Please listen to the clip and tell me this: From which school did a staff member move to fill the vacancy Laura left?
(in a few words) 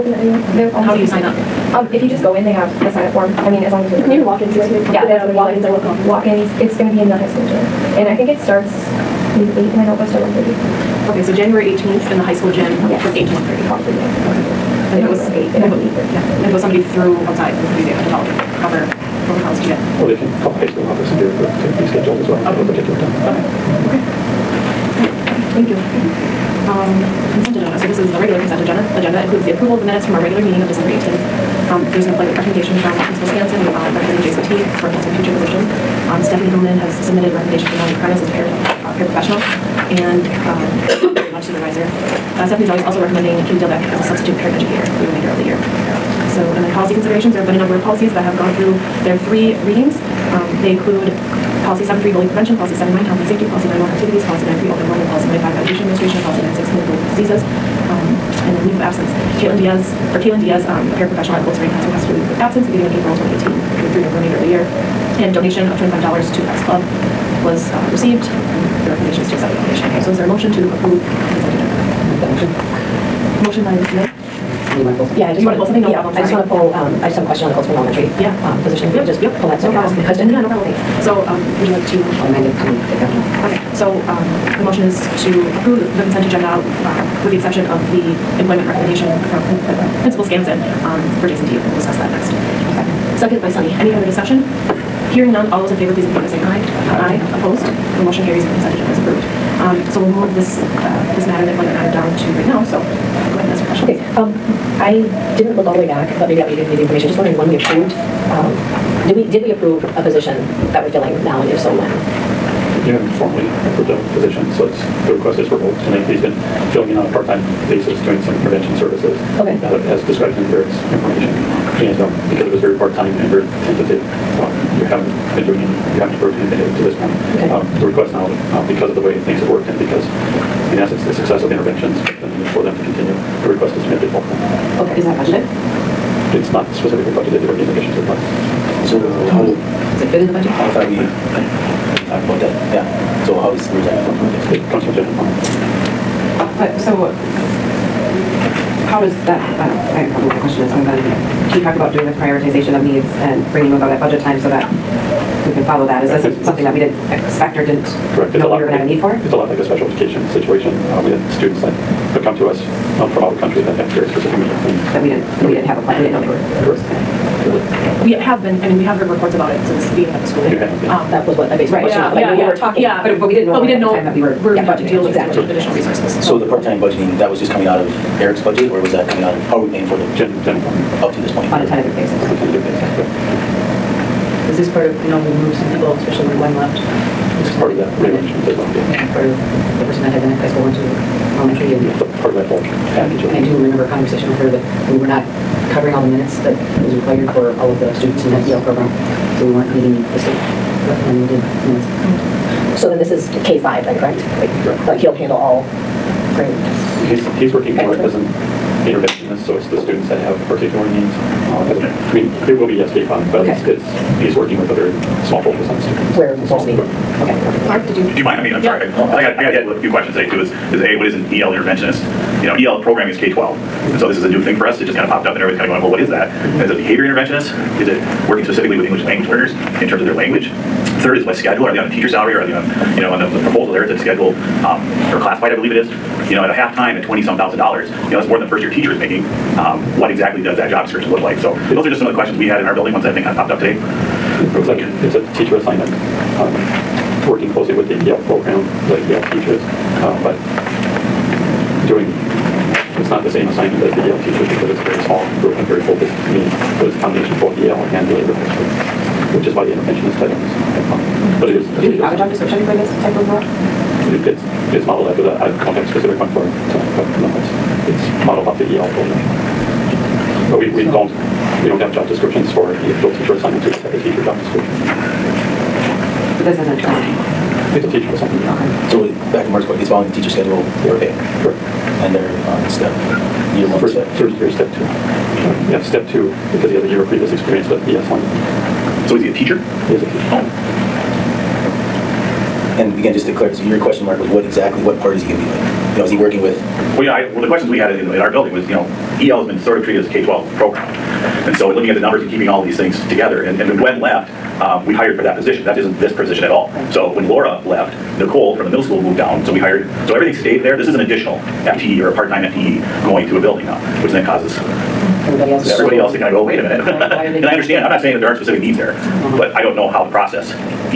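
middle school.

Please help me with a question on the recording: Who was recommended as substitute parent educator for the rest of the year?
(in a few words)
Katie Dilbeck.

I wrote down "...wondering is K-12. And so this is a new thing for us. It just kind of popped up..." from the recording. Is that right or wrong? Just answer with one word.
wrong.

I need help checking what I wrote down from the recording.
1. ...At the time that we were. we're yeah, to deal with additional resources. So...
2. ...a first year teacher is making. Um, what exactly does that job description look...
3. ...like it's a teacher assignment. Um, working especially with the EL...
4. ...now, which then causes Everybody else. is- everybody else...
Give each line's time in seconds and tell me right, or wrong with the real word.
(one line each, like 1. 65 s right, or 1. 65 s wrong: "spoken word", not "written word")
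1. 173 s right
2. 238 s right
3. 244 s wrong: "closely", not "especially"
4. 313 s right.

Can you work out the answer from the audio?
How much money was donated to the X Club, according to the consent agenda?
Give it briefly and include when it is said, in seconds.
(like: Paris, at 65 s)
$25, at 65 s.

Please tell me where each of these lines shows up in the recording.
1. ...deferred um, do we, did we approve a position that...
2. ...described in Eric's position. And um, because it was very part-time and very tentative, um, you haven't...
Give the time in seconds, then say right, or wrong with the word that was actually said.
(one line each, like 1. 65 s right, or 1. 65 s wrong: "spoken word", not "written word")
1. 107 s wrong: "approved", not "deferred"
2. 120 s wrong: "information", not "position".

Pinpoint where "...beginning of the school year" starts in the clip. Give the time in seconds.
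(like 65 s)
169 s.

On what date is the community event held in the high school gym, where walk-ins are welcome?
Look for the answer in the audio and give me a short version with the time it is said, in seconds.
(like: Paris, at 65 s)
January 18th, at 11 s.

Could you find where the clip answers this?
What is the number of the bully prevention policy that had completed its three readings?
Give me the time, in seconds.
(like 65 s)
51 s.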